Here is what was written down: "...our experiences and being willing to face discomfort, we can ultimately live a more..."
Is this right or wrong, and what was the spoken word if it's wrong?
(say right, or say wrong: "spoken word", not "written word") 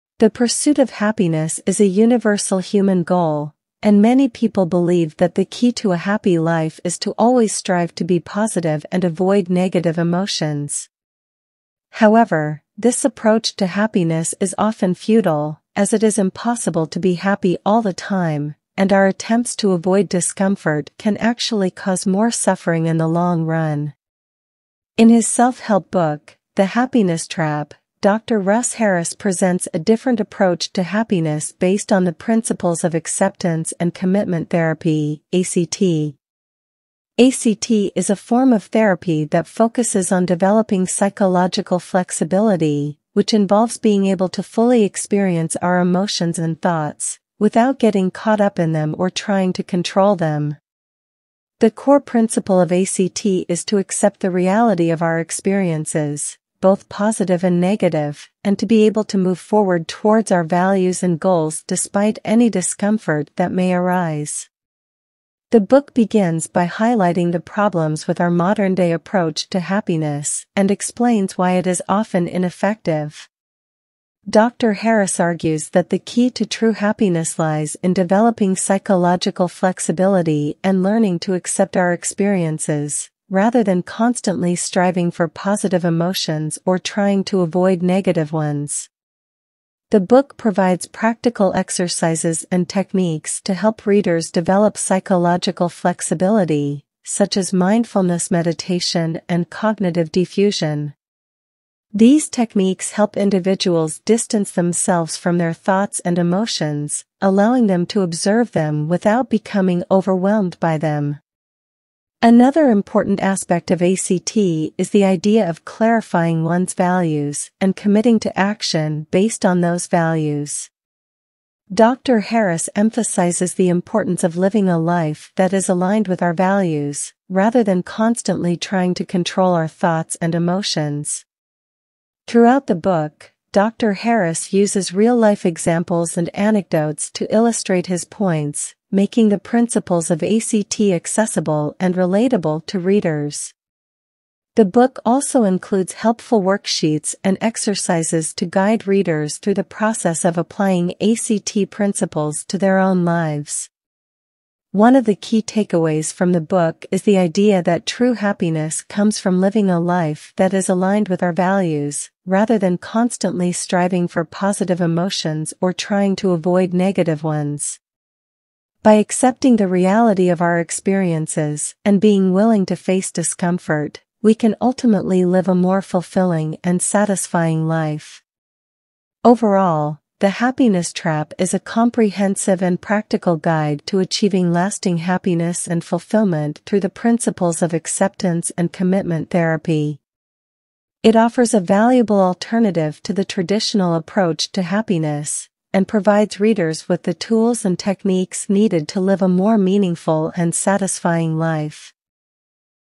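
right.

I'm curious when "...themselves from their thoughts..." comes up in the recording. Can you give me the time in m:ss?
1:44.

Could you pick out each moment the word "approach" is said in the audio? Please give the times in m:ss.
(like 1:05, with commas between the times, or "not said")
0:13, 0:30, 1:08, 3:13.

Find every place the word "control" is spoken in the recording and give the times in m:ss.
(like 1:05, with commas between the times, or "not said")
0:49, 2:09.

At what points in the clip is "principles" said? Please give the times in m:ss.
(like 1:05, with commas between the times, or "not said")
0:32, 0:52, 2:19, 2:31, 3:06.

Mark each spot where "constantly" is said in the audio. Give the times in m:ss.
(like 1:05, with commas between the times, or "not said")
1:23, 2:07, 2:42.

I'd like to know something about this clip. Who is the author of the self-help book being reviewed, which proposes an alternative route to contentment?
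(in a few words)
Dr. Russ Harris.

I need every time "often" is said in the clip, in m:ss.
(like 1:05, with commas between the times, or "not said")
0:14, 1:11.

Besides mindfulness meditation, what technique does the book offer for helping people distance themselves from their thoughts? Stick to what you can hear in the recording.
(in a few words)
cognitive diffusion.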